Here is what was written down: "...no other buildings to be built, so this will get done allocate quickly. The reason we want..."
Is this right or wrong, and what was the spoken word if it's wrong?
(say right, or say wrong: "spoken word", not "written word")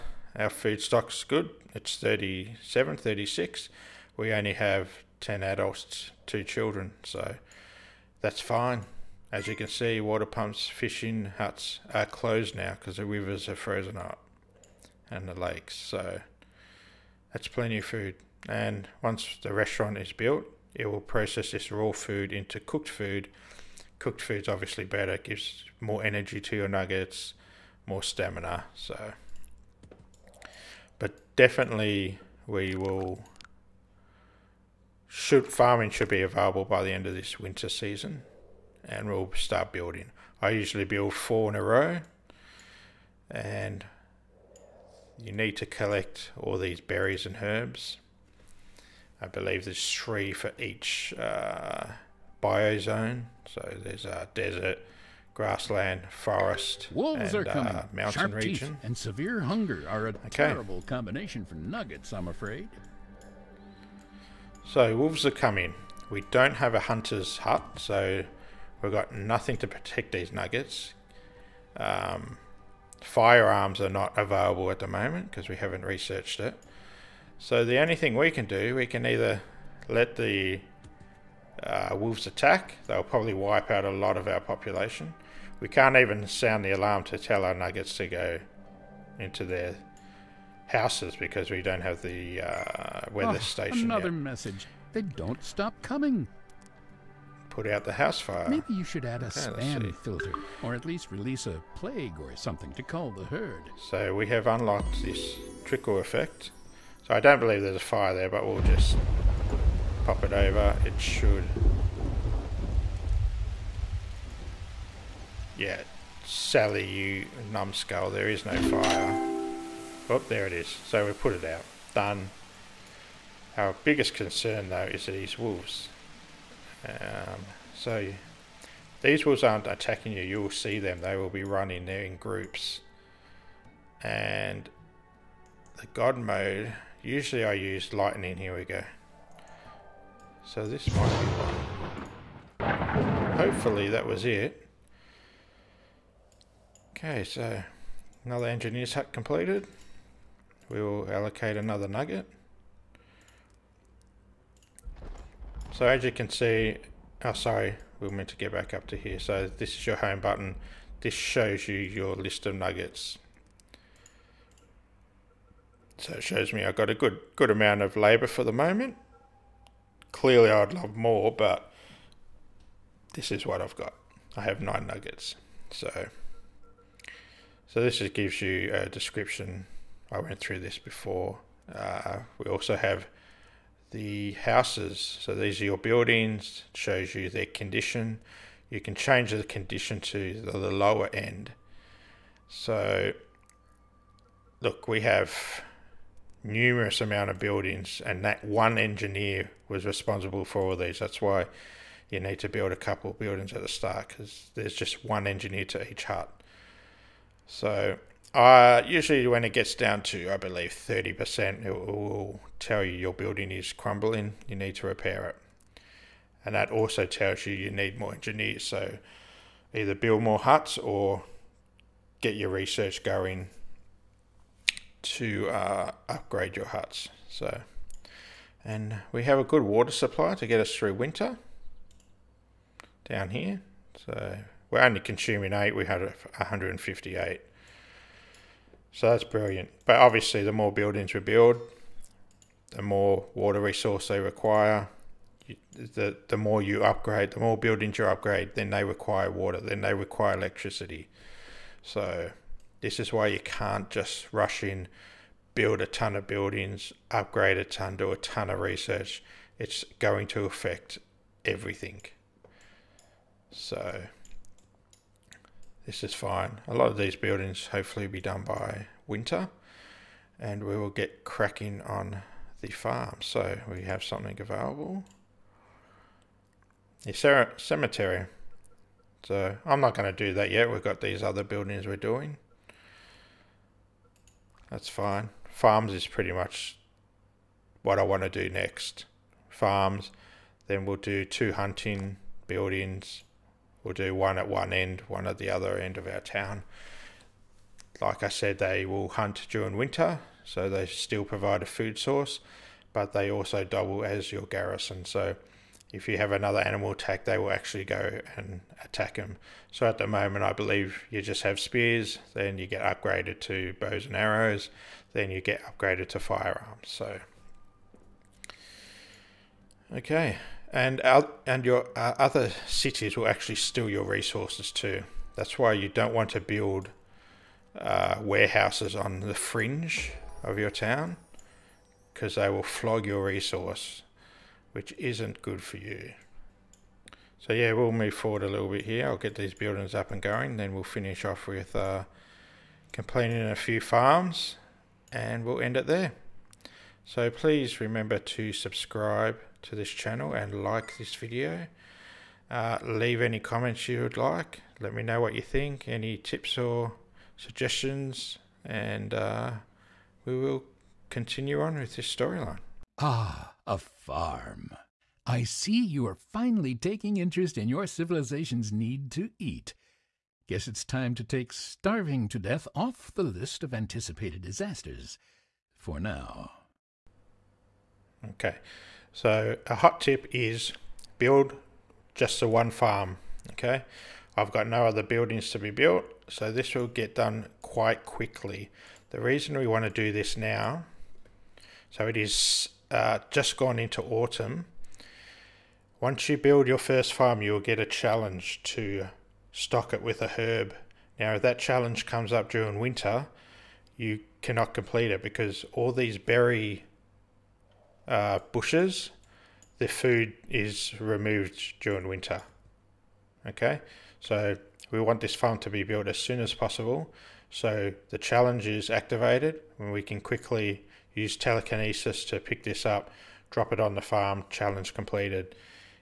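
wrong: "quite", not "allocate".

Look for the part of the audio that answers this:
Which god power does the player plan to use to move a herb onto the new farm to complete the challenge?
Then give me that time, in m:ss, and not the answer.
7:01.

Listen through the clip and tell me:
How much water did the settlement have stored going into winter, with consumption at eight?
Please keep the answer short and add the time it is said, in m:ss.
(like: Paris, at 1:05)
158, at 3:56.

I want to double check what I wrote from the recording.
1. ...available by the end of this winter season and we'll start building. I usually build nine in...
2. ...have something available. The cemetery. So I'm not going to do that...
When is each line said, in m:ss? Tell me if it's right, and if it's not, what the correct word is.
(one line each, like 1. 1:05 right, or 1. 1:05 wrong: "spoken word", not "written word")
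1. 0:36 wrong: "four", not "nine"
2. 4:33 right.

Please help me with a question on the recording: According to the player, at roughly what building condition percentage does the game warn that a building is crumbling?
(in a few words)
30%.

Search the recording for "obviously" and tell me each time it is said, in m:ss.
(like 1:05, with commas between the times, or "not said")
0:24, 3:59.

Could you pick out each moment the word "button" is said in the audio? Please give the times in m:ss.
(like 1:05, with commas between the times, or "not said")
2:40.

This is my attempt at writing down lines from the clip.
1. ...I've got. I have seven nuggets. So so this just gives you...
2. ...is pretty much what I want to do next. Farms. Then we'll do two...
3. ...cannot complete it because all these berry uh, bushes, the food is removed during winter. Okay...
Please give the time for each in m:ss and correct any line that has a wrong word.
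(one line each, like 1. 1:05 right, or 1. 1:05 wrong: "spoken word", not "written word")
1. 2:53 wrong: "nine", not "seven"
2. 4:45 right
3. 6:44 right.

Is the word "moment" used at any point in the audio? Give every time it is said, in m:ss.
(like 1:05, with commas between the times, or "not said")
1:14, 2:48, 5:10.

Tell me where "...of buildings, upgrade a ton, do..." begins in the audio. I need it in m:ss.
4:16.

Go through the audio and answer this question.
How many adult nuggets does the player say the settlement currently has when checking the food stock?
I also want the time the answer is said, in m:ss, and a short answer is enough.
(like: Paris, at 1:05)
10, at 0:05.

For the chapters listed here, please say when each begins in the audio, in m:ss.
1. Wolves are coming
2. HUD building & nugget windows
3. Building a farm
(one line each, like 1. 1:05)
1. 0:57
2. 2:36
3. 6:16.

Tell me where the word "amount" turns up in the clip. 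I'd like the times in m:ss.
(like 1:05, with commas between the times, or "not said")
2:47, 3:16.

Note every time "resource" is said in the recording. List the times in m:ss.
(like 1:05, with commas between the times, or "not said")
4:03, 5:24, 5:33.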